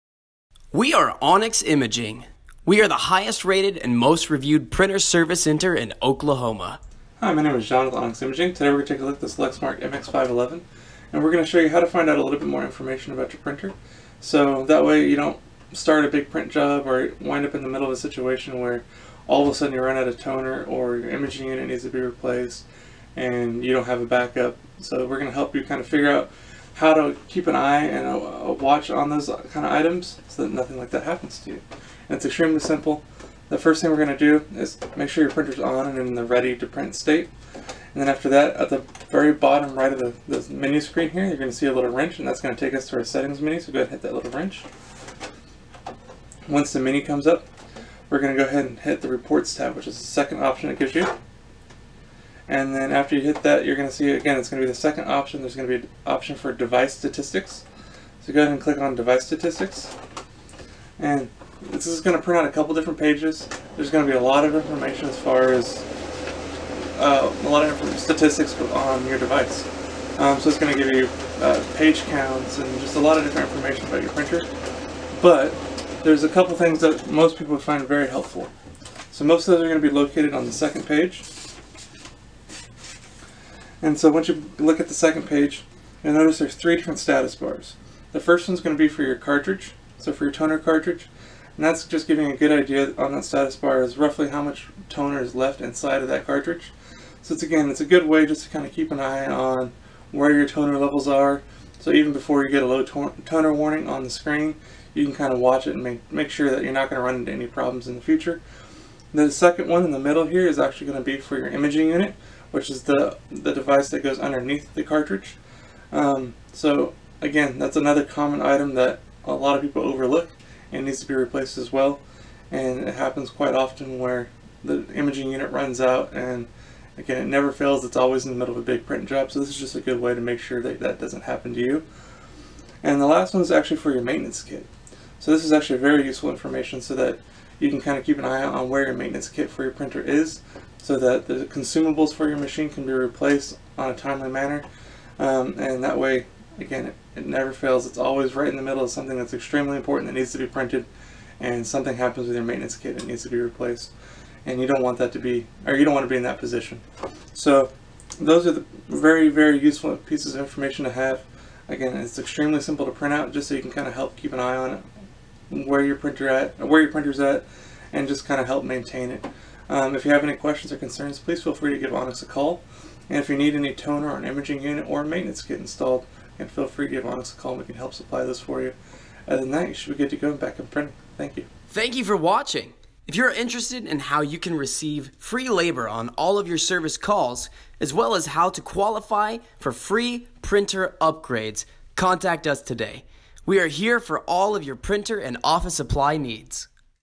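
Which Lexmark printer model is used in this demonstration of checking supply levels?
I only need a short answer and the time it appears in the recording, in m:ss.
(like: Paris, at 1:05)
MX511, at 0:09.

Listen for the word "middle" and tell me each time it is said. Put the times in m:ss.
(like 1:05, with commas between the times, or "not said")
0:17, 1:49, 2:08, 2:28.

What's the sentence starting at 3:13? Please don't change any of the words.
We are here for all of your printer and office supply needs.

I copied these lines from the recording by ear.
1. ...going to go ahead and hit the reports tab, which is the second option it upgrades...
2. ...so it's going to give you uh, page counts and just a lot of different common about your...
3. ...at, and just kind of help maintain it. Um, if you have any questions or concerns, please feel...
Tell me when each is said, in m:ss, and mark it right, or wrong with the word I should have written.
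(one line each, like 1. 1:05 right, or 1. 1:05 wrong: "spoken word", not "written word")
1. 0:48 wrong: "gives", not "upgrades"
2. 1:10 wrong: "information", not "common"
3. 2:47 right.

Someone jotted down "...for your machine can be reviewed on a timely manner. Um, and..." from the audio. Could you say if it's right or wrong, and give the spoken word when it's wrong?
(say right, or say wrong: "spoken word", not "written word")
wrong: "replaced", not "reviewed".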